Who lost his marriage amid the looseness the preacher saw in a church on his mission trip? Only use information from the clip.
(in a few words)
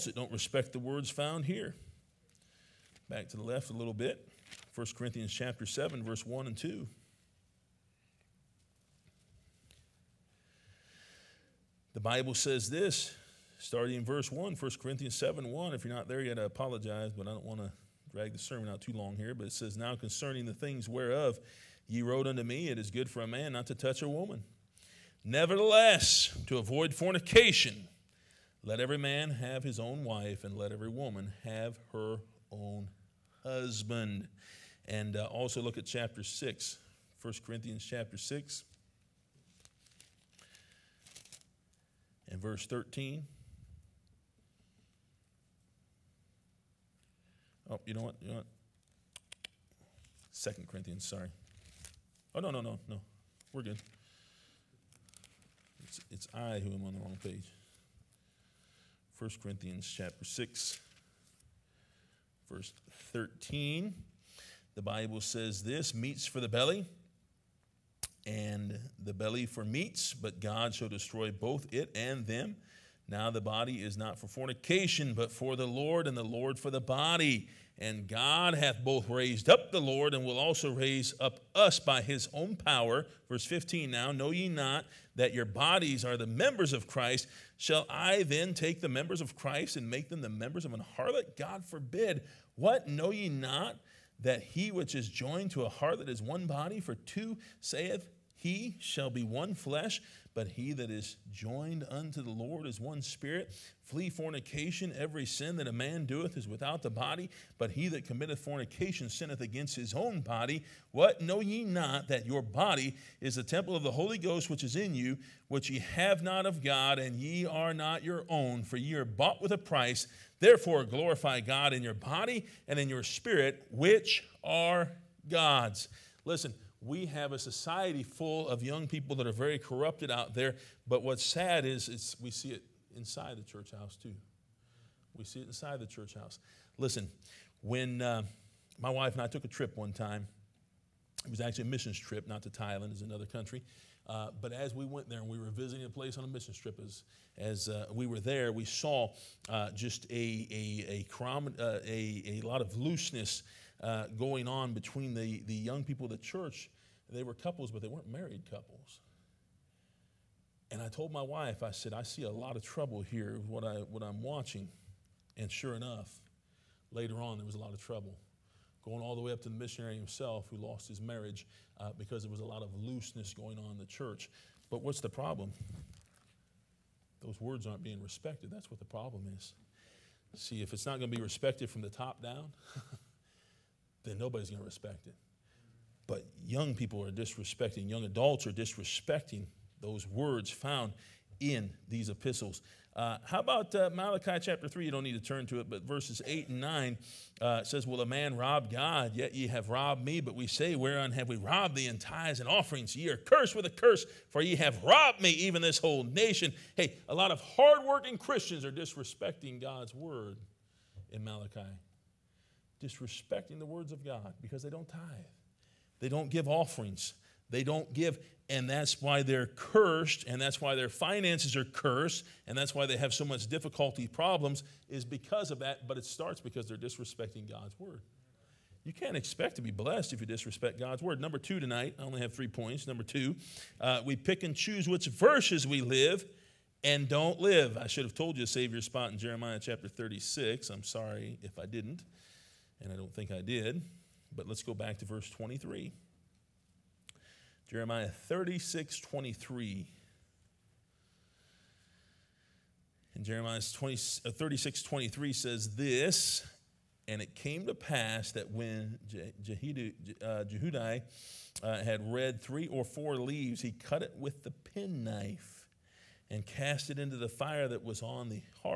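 The missionary.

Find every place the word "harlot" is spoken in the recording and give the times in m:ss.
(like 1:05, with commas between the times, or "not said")
1:30, 1:35.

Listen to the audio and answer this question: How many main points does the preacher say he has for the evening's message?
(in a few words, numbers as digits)
3.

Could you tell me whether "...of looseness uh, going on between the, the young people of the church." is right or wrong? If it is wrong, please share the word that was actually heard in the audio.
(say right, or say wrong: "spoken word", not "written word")
right.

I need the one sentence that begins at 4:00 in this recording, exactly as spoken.
I'm sorry if I didn't and I don't think I did.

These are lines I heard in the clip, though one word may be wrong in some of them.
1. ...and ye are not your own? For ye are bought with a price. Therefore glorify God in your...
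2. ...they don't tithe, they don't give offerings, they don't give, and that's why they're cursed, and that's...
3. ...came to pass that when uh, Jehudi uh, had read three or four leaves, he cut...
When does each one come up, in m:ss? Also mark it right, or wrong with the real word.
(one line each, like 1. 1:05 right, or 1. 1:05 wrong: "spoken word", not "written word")
1. 1:56 right
2. 3:34 right
3. 4:17 right.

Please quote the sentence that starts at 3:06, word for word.
But young people are disrespecting, young adults are disrespecting those words found in these epistles.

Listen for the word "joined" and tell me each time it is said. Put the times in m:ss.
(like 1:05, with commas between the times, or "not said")
1:35, 1:41.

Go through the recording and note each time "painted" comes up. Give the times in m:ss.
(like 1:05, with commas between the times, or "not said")
not said.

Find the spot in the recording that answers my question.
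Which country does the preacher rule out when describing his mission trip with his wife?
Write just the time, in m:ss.
2:22.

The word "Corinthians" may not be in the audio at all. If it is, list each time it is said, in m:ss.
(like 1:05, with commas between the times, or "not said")
0:04, 0:14, 0:37, 0:50, 0:59.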